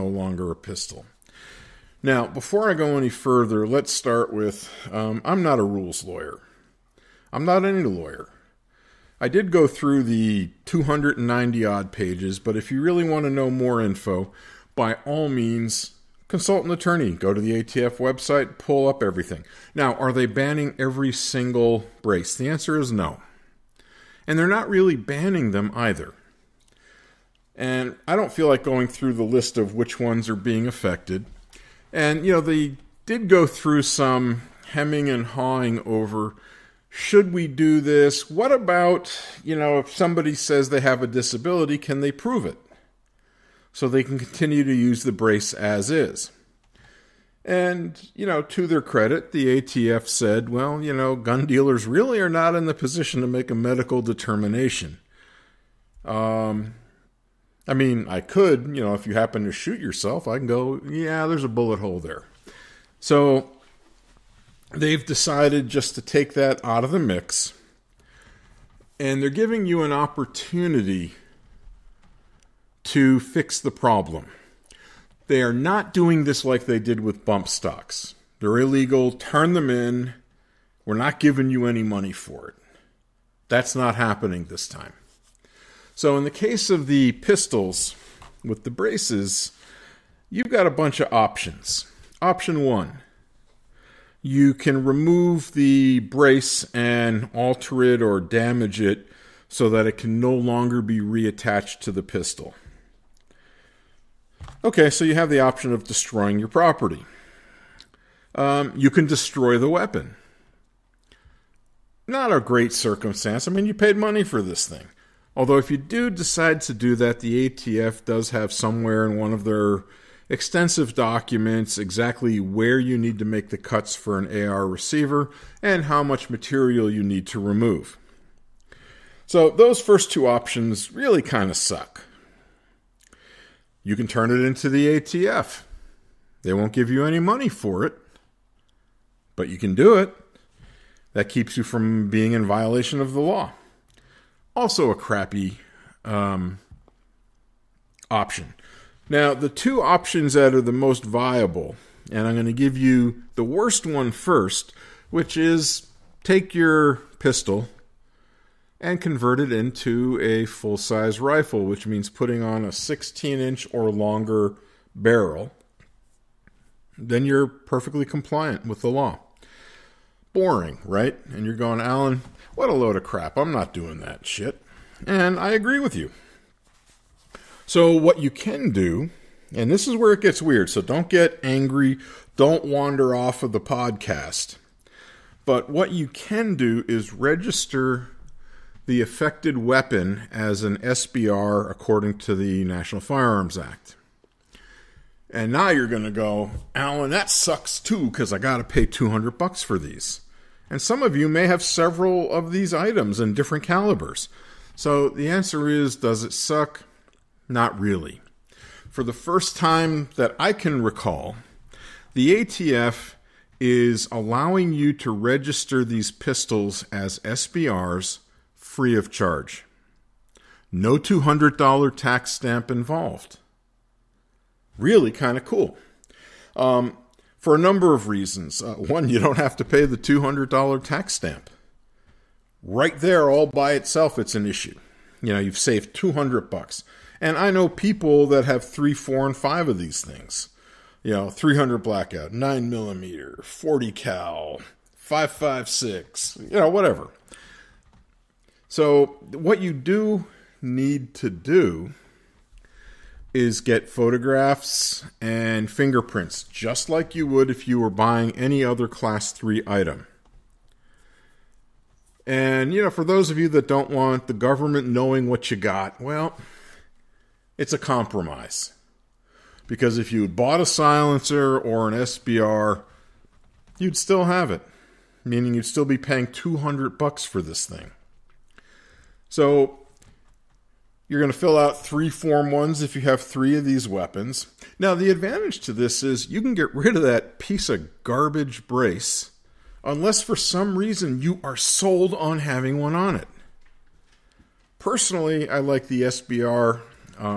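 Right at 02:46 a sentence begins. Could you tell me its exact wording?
Then you're perfectly compliant with the law.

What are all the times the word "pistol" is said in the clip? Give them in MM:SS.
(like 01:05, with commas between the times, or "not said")
00:00, 01:27, 01:42, 02:37, 03:36.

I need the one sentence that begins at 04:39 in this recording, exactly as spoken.
So you're going to fill out three form ones if you have three of these weapons.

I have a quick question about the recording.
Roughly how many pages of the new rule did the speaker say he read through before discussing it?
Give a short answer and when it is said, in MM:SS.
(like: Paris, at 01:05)
290, at 00:10.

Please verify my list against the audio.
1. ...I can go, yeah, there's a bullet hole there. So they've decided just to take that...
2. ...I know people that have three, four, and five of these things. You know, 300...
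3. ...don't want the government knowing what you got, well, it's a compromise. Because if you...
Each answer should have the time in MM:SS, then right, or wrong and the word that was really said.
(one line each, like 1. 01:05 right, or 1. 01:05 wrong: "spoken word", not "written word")
1. 01:00 right
2. 03:57 right
3. 04:23 right.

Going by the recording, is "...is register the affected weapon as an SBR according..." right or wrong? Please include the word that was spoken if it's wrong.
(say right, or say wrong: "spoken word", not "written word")
right.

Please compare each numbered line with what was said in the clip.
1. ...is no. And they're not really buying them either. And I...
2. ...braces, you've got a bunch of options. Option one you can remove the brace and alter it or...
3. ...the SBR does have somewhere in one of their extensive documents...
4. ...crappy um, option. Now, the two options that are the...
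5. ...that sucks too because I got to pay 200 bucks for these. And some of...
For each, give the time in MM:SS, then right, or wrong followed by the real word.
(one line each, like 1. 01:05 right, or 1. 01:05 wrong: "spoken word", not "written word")
1. 00:22 wrong: "banning", not "buying"
2. 01:28 right
3. 01:57 wrong: "ATF", not "SBR"
4. 02:24 right
5. 03:17 right.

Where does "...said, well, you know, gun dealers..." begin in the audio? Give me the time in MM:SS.
00:50.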